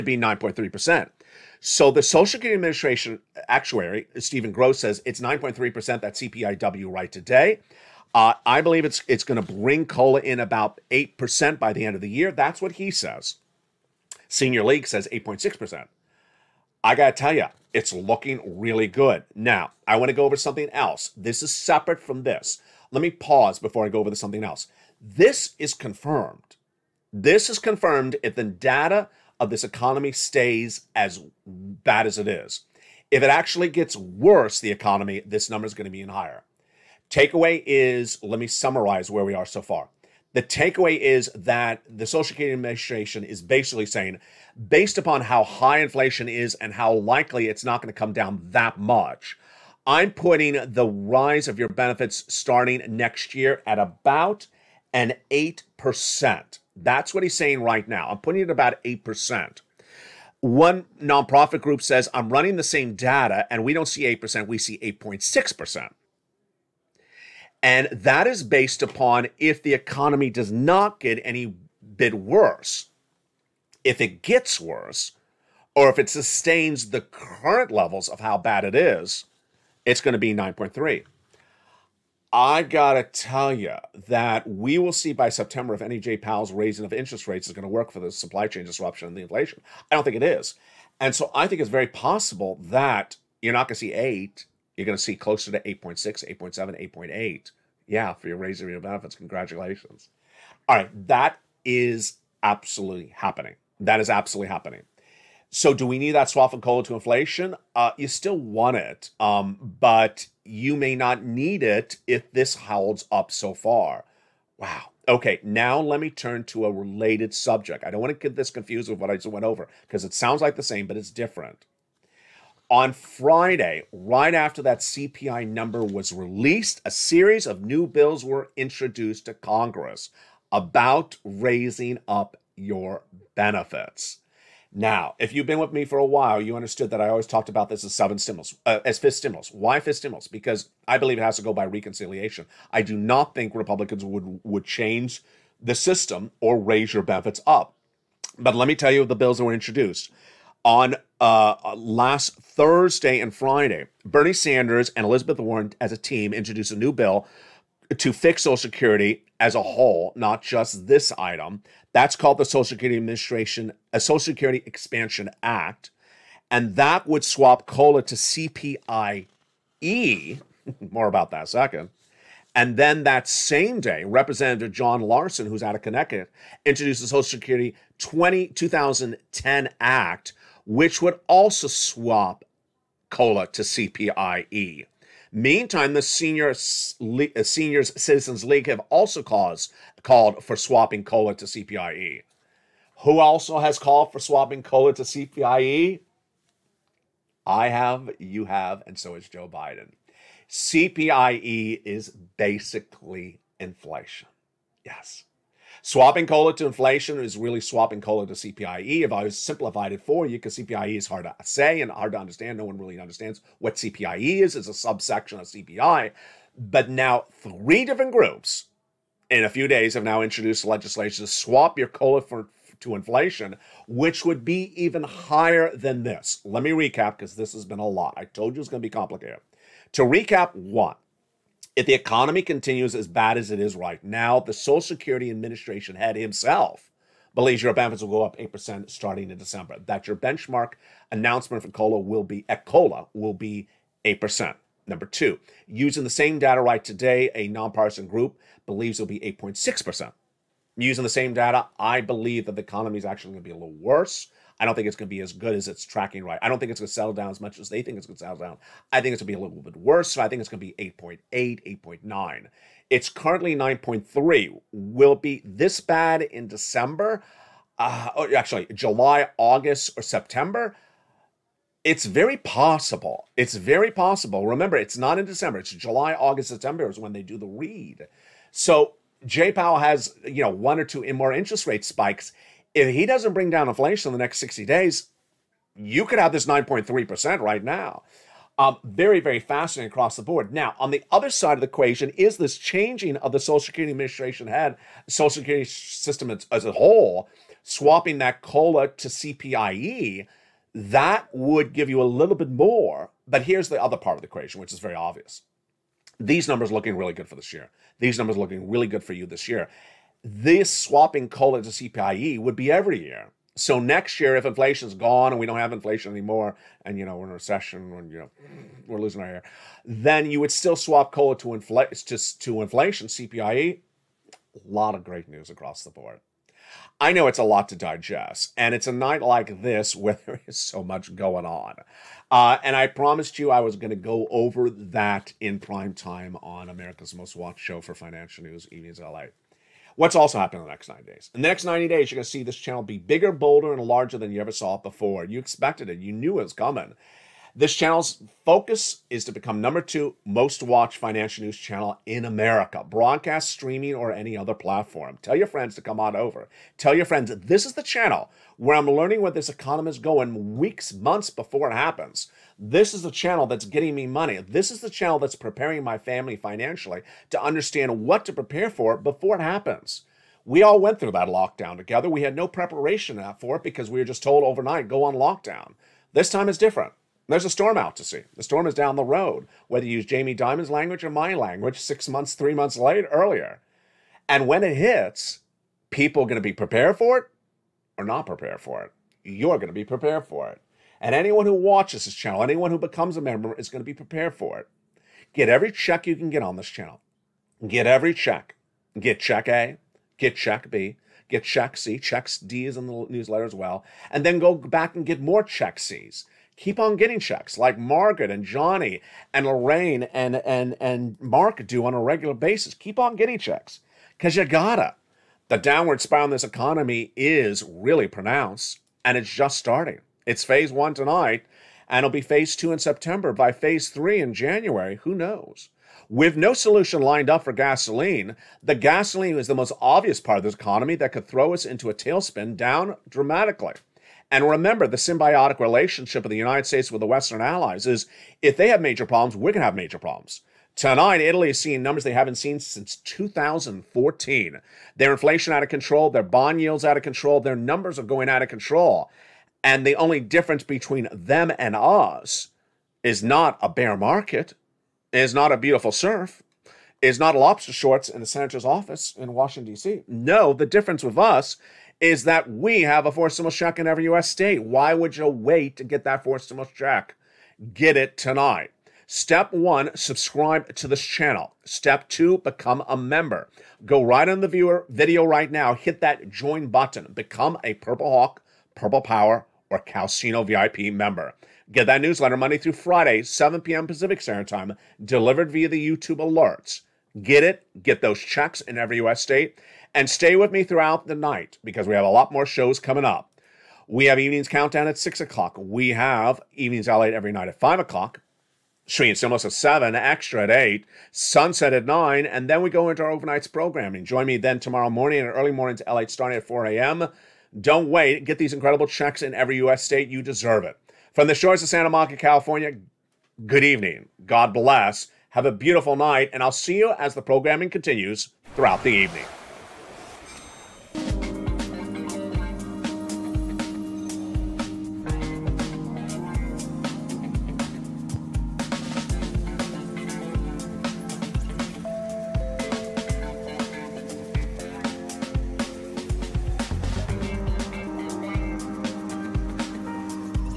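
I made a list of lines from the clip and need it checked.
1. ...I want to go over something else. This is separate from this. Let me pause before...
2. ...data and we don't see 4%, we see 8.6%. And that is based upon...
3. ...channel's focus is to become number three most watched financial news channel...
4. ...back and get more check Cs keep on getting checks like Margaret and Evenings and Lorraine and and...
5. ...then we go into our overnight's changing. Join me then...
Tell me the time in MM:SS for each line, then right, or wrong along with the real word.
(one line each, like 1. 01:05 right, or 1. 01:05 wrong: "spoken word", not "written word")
1. 00:19 right
2. 01:02 wrong: "8", not "4"
3. 05:47 wrong: "two", not "three"
4. 06:44 wrong: "Johnny", not "Evenings"
5. 08:22 wrong: "programming", not "changing".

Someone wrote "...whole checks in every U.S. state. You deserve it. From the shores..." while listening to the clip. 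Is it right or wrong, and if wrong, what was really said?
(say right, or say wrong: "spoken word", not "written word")
wrong: "incredible", not "whole".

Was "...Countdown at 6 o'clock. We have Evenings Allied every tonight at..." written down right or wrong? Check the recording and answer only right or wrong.
wrong.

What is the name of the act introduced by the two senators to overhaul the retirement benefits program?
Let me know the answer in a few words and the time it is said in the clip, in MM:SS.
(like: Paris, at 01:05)
Social Security Expansion Act, at 02:43.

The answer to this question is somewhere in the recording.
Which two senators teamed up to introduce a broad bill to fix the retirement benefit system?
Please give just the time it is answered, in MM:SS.
02:34.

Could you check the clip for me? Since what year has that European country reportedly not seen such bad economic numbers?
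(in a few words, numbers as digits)
2014.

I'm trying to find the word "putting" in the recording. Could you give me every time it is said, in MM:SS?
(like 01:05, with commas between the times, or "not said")
00:50, 00:58.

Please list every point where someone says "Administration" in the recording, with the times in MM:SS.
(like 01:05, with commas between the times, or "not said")
00:02, 00:42, 02:42, 03:55, 04:53.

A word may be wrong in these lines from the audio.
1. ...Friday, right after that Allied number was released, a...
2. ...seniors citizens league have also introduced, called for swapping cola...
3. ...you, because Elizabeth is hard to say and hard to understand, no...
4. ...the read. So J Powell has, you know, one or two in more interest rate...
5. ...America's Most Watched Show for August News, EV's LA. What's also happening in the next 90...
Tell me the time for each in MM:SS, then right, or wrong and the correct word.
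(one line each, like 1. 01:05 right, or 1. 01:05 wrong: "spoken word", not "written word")
1. 02:02 wrong: "CPI", not "Allied"
2. 03:07 wrong: "caused", not "introduced"
3. 03:30 wrong: "CPIE", not "Elizabeth"
4. 04:37 right
5. 05:36 wrong: "Financial", not "August".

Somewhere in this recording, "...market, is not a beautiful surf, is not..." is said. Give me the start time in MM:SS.
07:33.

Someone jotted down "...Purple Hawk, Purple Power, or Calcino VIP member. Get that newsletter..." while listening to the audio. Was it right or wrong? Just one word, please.
right.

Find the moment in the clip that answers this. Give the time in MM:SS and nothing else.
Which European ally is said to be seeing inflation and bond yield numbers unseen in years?
07:21.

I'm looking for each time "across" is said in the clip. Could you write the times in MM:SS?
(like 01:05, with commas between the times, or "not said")
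04:49, 05:25.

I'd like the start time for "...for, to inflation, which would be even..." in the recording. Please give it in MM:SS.
03:42.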